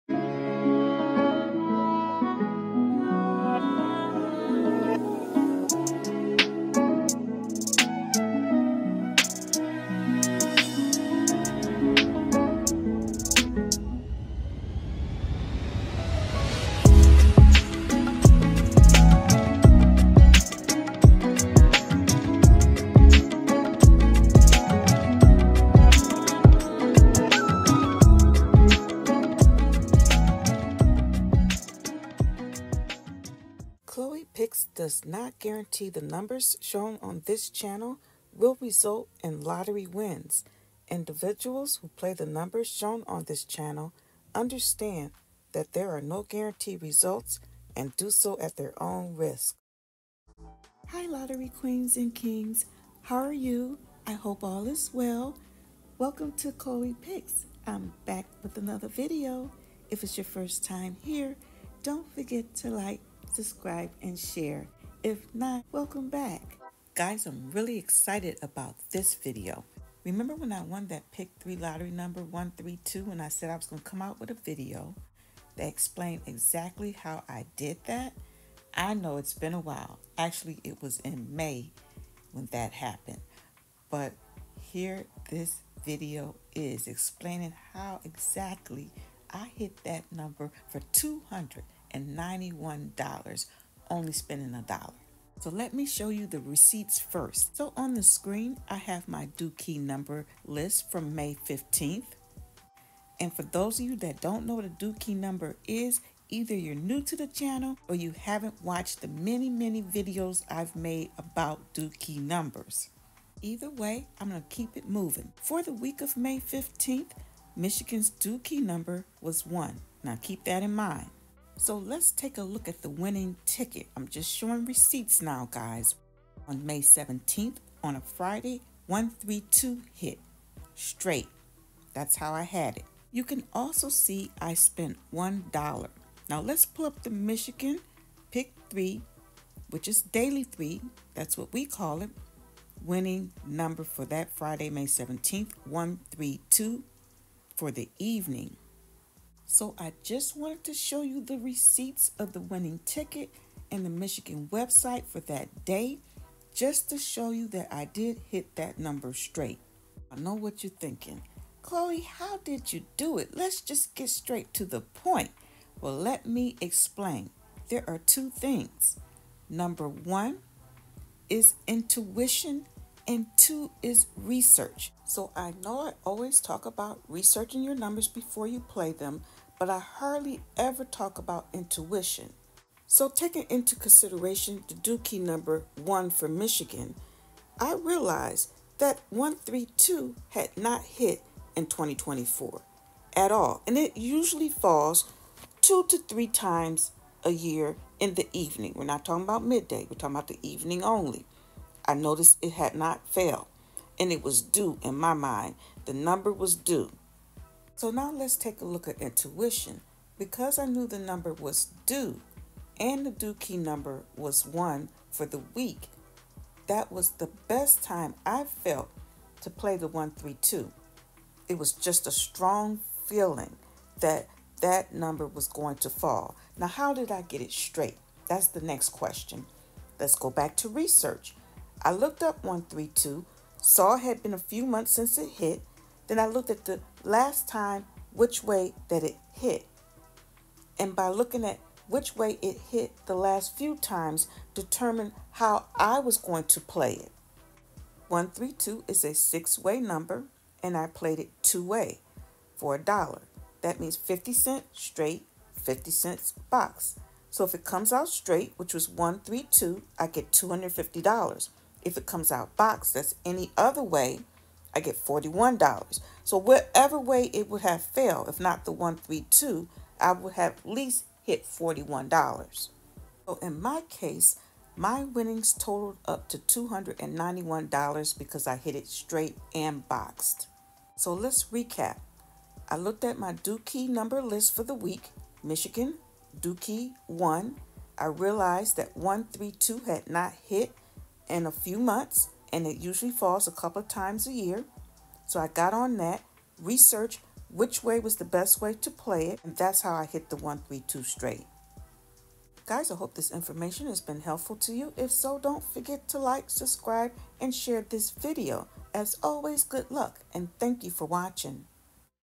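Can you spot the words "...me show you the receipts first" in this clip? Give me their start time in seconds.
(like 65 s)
95 s.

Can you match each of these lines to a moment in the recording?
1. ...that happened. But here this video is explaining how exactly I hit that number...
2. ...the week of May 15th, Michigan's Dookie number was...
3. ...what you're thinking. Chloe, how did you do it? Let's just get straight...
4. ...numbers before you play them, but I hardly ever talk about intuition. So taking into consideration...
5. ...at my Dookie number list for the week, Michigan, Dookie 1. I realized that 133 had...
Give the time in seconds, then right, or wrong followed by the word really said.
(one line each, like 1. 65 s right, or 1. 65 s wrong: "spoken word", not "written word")
1. 82 s right
2. 115 s right
3. 160 s right
4. 177 s right
5. 283 s wrong: "132", not "133".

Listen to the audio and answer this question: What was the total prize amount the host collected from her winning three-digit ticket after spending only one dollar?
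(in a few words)
$291.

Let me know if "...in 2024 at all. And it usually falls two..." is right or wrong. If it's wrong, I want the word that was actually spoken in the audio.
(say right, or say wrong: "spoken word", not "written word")
right.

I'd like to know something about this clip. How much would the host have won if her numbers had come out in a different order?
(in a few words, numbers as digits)
$41.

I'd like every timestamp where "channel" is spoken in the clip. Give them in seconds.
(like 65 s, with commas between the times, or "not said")
37 s, 43 s, 107 s.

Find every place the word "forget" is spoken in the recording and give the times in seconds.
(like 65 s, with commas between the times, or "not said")
62 s, 305 s.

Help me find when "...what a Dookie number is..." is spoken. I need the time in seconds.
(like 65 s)
104 s.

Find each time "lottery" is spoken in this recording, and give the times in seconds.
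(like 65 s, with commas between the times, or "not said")
39 s, 51 s, 71 s.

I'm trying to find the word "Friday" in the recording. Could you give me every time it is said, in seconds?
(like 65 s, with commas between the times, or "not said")
128 s, 144 s.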